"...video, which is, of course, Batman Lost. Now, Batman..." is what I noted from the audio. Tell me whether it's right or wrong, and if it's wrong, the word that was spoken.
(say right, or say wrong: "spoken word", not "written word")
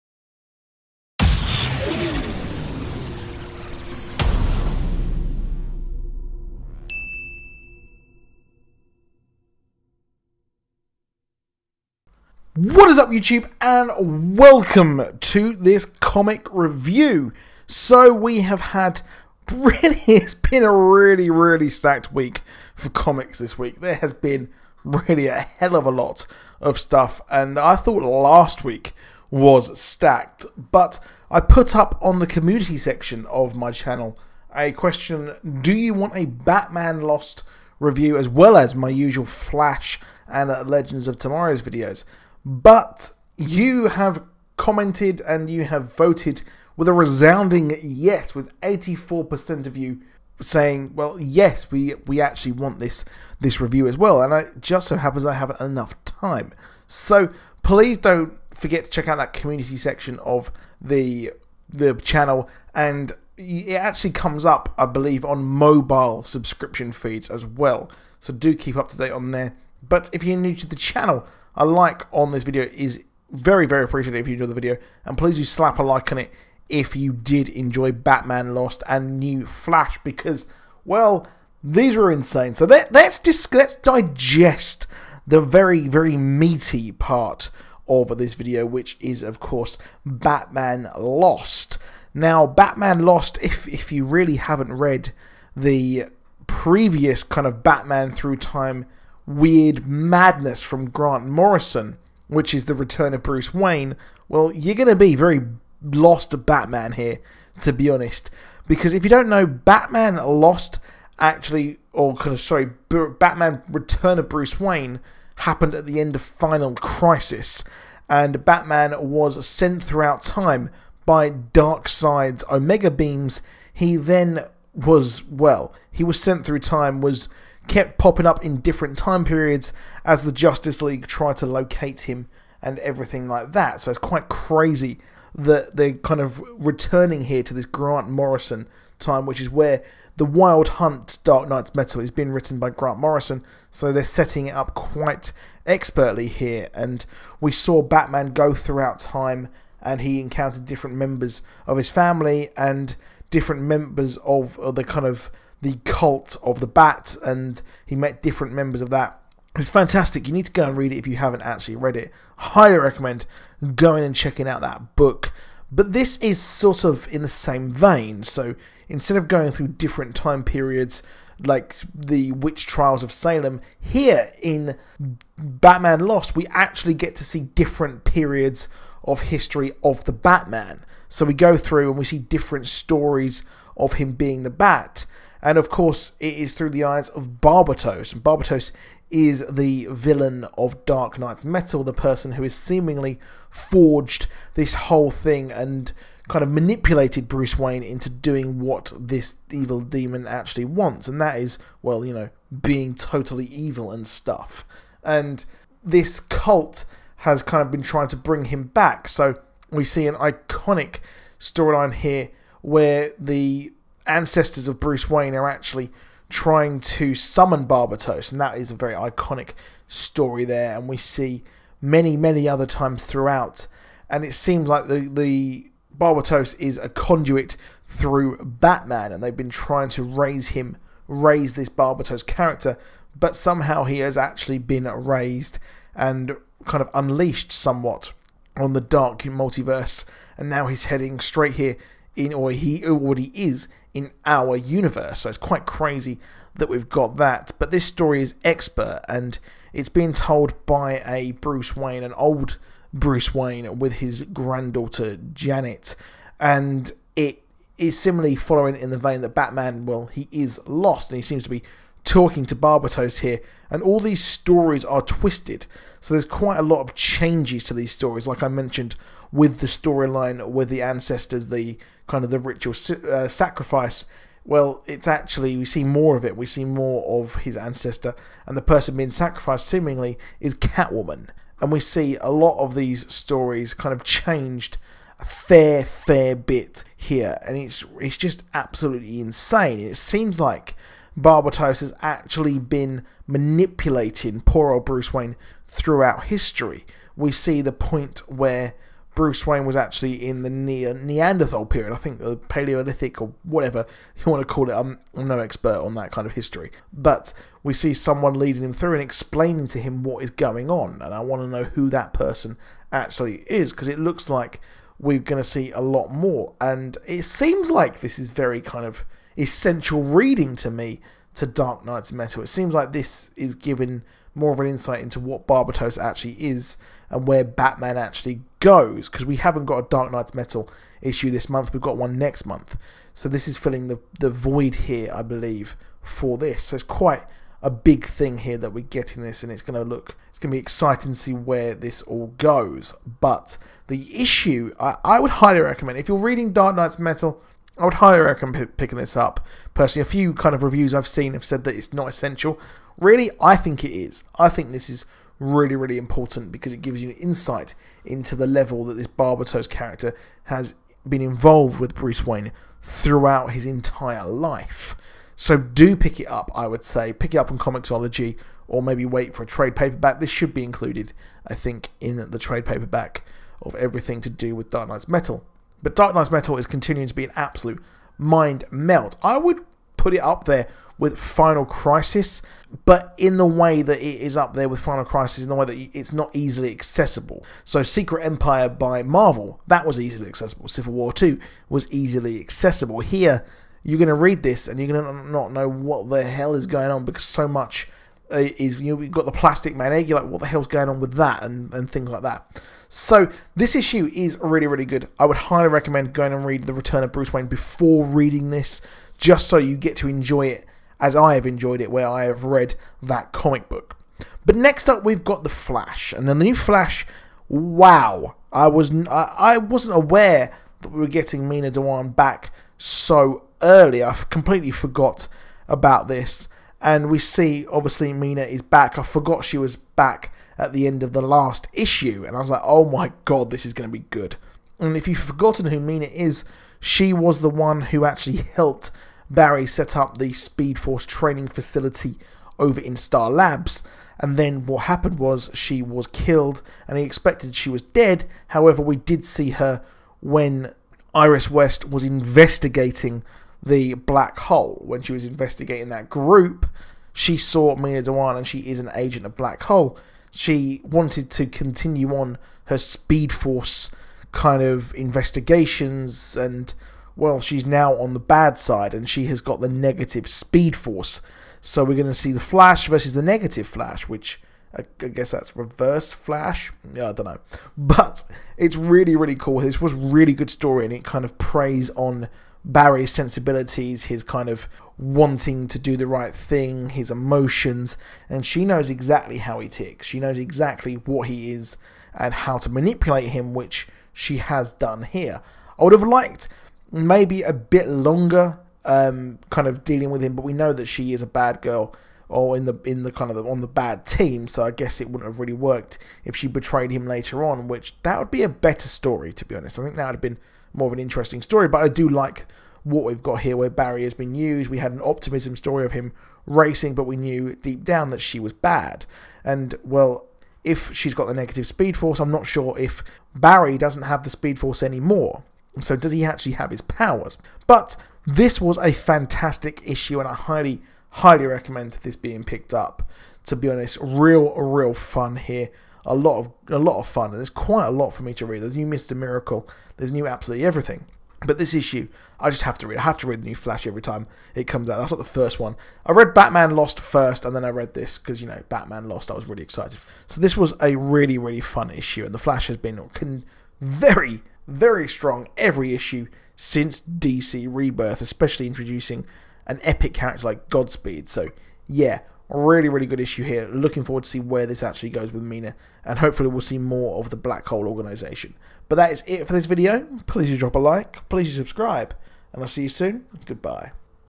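right.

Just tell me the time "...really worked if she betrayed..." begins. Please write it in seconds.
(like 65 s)
505 s.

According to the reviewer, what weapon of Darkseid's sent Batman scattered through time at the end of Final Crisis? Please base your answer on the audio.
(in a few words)
Omega Beams.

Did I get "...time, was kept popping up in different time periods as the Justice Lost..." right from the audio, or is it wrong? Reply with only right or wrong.
wrong.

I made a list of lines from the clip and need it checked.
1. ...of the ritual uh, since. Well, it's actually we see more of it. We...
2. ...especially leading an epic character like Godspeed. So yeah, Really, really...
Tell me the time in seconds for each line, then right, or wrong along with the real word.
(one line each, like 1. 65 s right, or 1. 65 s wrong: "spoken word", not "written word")
1. 272 s wrong: "sacrifice", not "since"
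2. 558 s wrong: "introducing", not "leading".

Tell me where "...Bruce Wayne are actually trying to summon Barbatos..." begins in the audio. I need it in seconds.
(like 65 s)
214 s.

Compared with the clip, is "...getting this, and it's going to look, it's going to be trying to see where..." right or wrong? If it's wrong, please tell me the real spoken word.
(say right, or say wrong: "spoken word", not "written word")
wrong: "exciting", not "trying".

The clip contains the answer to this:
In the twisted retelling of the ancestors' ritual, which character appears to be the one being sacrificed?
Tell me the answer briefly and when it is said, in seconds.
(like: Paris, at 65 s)
Catwoman, at 280 s.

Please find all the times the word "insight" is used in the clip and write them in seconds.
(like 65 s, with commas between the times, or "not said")
324 s, 357 s.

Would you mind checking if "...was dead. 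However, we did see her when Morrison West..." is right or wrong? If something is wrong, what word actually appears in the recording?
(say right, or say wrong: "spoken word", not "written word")
wrong: "Iris", not "Morrison".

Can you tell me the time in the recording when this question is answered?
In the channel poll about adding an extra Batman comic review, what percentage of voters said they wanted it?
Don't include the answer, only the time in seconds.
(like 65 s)
48 s.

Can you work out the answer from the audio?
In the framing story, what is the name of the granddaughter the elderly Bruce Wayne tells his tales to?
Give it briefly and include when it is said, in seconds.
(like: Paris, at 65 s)
Janet, at 255 s.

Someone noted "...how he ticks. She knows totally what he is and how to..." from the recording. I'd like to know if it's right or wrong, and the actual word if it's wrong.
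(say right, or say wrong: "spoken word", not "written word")
wrong: "exactly", not "totally".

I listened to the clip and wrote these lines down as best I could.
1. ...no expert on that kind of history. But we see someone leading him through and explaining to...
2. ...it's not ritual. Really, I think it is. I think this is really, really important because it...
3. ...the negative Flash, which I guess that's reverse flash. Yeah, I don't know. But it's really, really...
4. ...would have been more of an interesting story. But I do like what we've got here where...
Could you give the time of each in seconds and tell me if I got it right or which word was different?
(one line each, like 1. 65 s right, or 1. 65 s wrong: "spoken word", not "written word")
1. 305 s right
2. 351 s wrong: "essential", not "ritual"
3. 473 s right
4. 510 s right.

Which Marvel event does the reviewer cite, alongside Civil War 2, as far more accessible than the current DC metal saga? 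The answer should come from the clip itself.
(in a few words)
Secret Empire.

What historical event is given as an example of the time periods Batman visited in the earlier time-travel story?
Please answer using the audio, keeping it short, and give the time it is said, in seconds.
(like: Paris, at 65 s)
witch trials of Salem, at 172 s.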